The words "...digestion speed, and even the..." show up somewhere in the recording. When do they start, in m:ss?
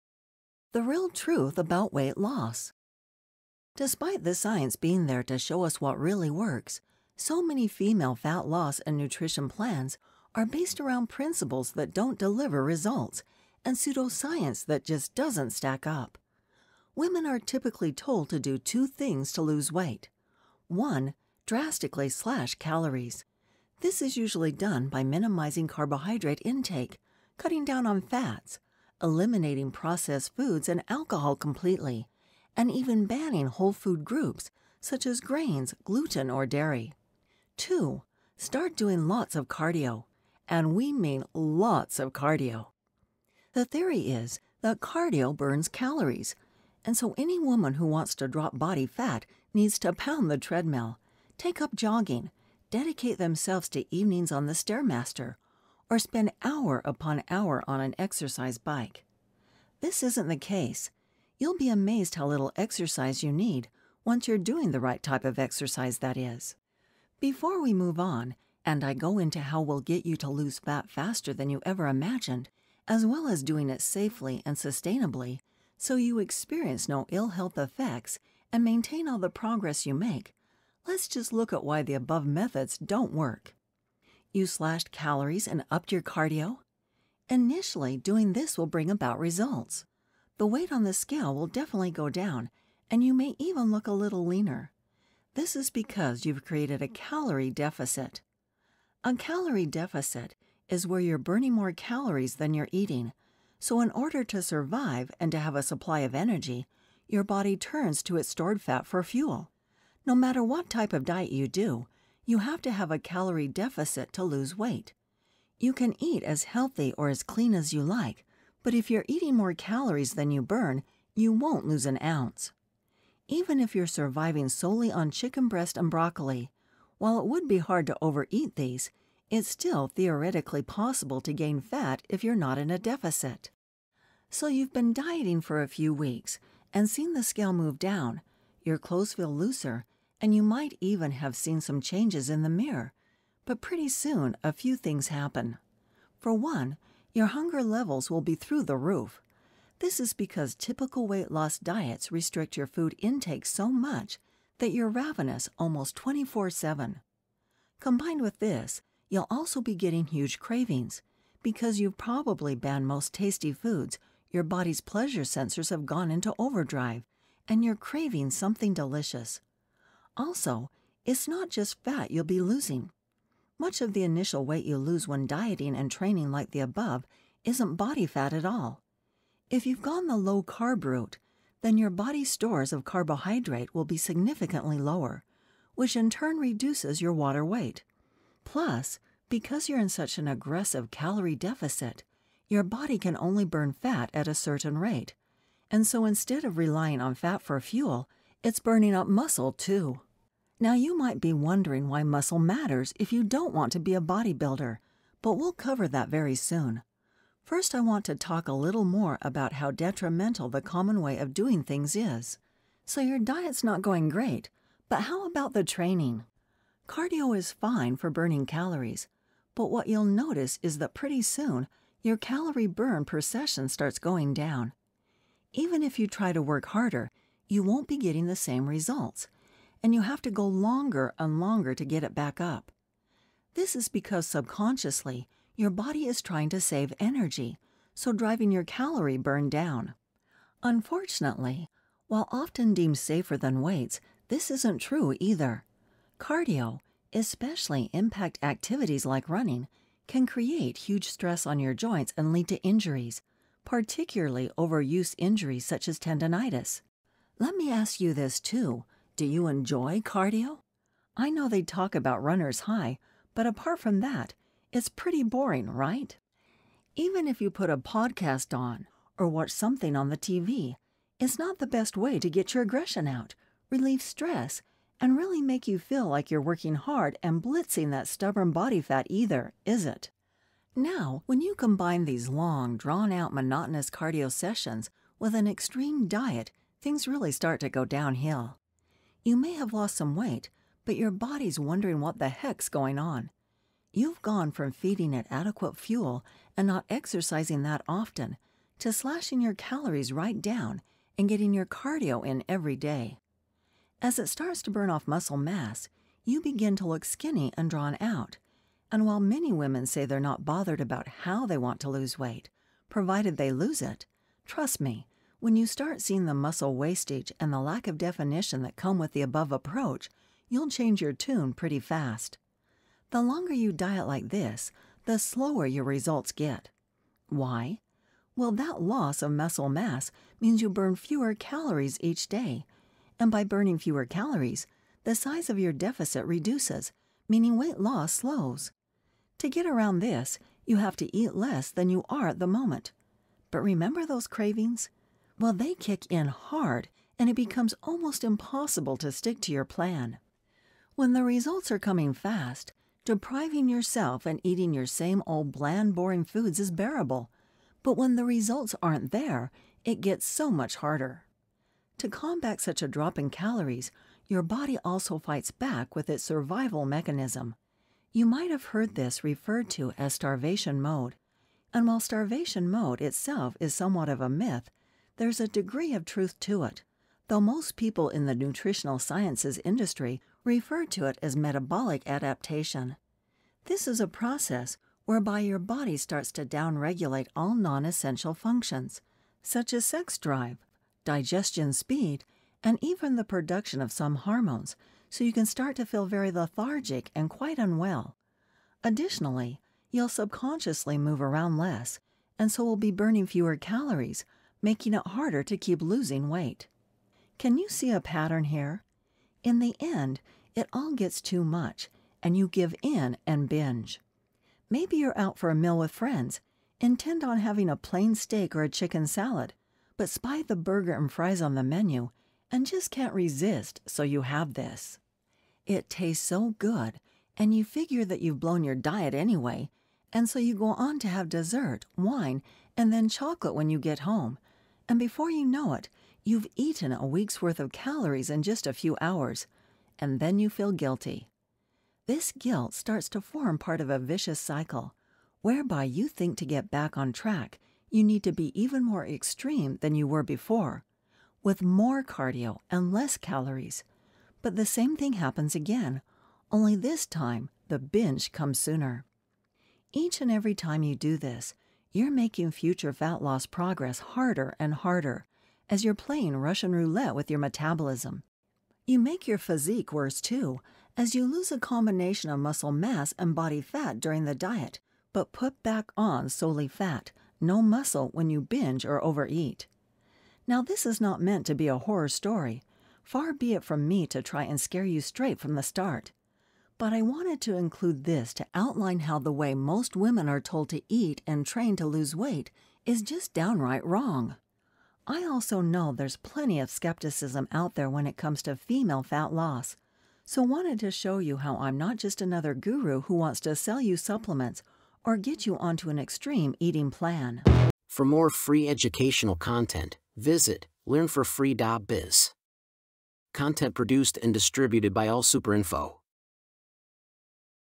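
6:31.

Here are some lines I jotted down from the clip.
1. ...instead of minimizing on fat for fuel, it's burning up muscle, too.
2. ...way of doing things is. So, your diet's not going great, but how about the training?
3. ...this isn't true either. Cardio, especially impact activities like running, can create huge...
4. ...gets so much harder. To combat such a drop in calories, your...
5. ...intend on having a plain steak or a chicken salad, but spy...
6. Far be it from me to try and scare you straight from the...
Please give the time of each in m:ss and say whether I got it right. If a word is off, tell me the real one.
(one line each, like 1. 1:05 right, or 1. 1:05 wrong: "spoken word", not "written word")
1. 3:16 wrong: "relying", not "minimizing"
2. 3:31 right
3. 4:04 right
4. 6:00 right
5. 6:56 right
6. 8:03 right.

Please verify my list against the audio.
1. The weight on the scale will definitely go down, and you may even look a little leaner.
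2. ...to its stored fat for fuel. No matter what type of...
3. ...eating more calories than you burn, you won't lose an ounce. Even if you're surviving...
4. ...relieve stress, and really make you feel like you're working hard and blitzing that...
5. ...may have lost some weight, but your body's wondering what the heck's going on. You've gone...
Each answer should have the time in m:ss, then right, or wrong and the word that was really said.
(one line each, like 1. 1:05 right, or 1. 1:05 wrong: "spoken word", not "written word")
1. 1:30 right
2. 1:48 right
3. 1:59 right
4. 4:33 right
5. 4:49 right.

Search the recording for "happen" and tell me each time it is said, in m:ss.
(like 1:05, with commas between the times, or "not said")
2:25, 7:35.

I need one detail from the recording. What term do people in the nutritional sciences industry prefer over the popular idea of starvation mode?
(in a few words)
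metabolic adaptation.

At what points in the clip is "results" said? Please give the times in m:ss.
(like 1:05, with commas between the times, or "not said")
0:12, 1:29, 3:48, 5:25, 5:51, 5:58.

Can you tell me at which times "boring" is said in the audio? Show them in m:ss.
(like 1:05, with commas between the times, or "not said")
4:25, 5:55.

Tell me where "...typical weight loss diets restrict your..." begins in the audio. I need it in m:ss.
2:30.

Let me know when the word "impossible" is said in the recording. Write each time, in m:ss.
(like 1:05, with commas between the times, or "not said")
5:48.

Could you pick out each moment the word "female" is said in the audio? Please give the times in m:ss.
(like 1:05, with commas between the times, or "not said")
0:07, 8:18.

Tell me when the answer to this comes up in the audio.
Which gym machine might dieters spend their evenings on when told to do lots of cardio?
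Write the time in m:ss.
0:54.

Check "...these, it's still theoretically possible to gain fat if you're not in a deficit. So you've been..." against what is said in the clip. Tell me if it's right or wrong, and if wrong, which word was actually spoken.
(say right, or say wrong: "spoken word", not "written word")
right.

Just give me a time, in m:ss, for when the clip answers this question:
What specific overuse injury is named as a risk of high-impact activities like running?
4:15.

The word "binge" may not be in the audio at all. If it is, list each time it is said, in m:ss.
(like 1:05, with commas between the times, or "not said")
6:53, 7:37, 7:58.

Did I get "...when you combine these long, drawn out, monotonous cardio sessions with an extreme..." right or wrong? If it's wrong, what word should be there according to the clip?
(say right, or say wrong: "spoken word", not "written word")
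right.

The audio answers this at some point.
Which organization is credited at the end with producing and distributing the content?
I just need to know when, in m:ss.
8:35.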